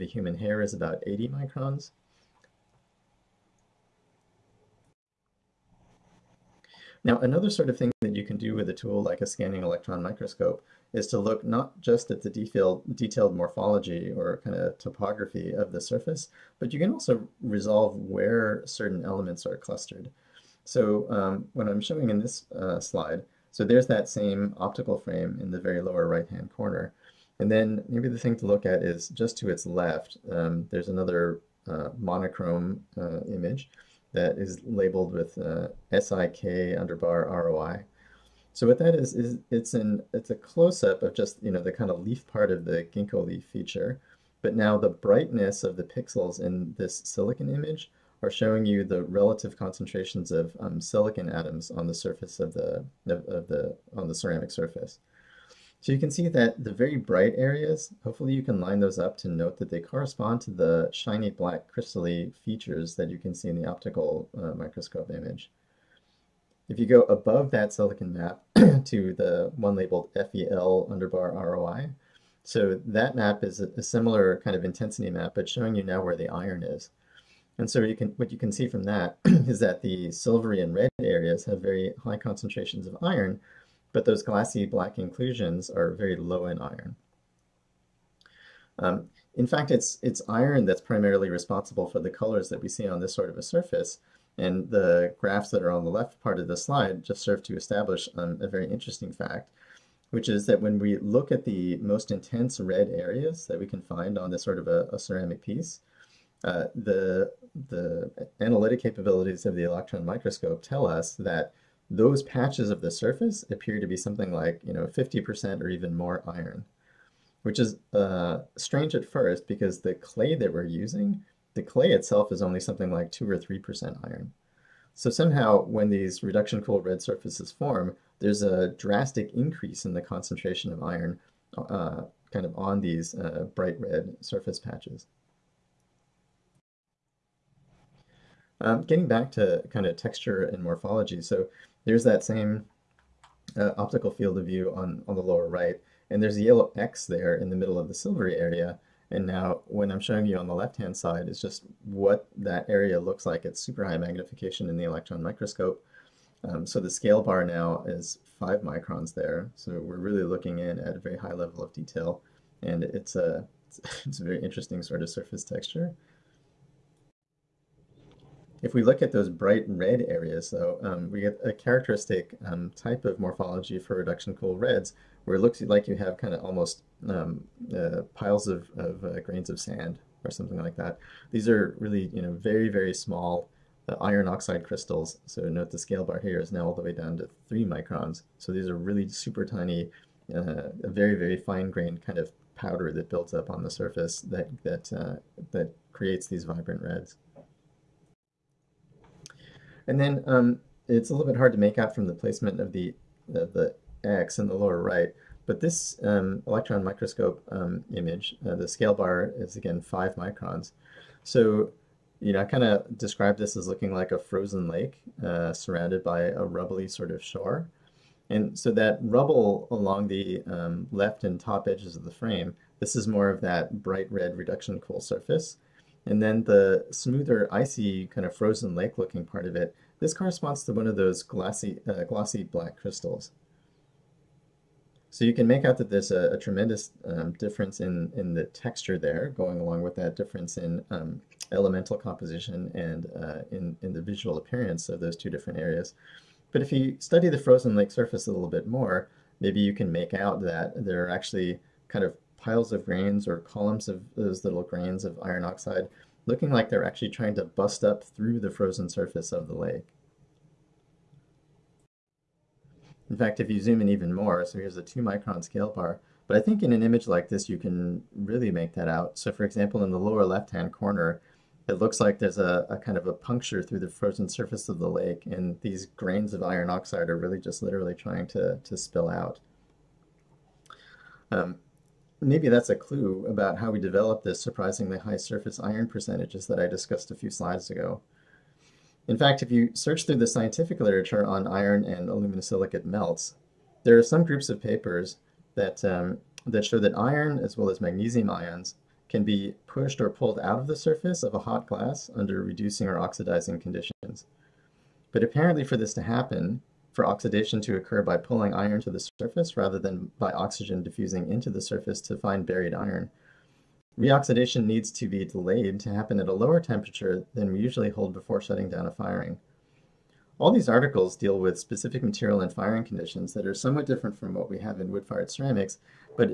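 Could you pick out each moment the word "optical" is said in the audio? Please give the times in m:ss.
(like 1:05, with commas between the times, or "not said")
0:24, 1:03, 2:23.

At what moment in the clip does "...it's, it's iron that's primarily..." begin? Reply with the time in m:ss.
1:29.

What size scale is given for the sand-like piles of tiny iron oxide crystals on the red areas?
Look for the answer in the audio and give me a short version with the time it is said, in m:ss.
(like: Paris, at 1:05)
3 microns, at 3:07.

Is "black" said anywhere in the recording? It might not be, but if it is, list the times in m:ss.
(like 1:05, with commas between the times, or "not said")
1:01, 1:24, 3:52.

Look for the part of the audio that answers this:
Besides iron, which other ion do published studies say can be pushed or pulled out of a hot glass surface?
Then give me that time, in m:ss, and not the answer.
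4:57.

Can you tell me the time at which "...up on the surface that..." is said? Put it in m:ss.
3:13.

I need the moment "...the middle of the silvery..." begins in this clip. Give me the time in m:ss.
2:27.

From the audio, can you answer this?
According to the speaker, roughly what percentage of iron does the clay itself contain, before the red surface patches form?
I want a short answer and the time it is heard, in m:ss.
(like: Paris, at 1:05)
2 or 3%, at 2:03.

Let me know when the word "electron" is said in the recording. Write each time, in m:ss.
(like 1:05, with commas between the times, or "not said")
0:09, 1:49, 2:34, 3:26.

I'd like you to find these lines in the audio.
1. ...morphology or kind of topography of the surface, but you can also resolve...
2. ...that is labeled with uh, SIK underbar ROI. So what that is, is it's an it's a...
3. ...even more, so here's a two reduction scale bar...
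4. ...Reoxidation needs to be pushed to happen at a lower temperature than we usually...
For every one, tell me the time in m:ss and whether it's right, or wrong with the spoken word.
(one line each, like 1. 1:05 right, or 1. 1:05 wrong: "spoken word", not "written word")
1. 0:13 right
2. 0:34 right
3. 4:23 wrong: "micron", not "reduction"
4. 5:13 wrong: "delayed", not "pushed".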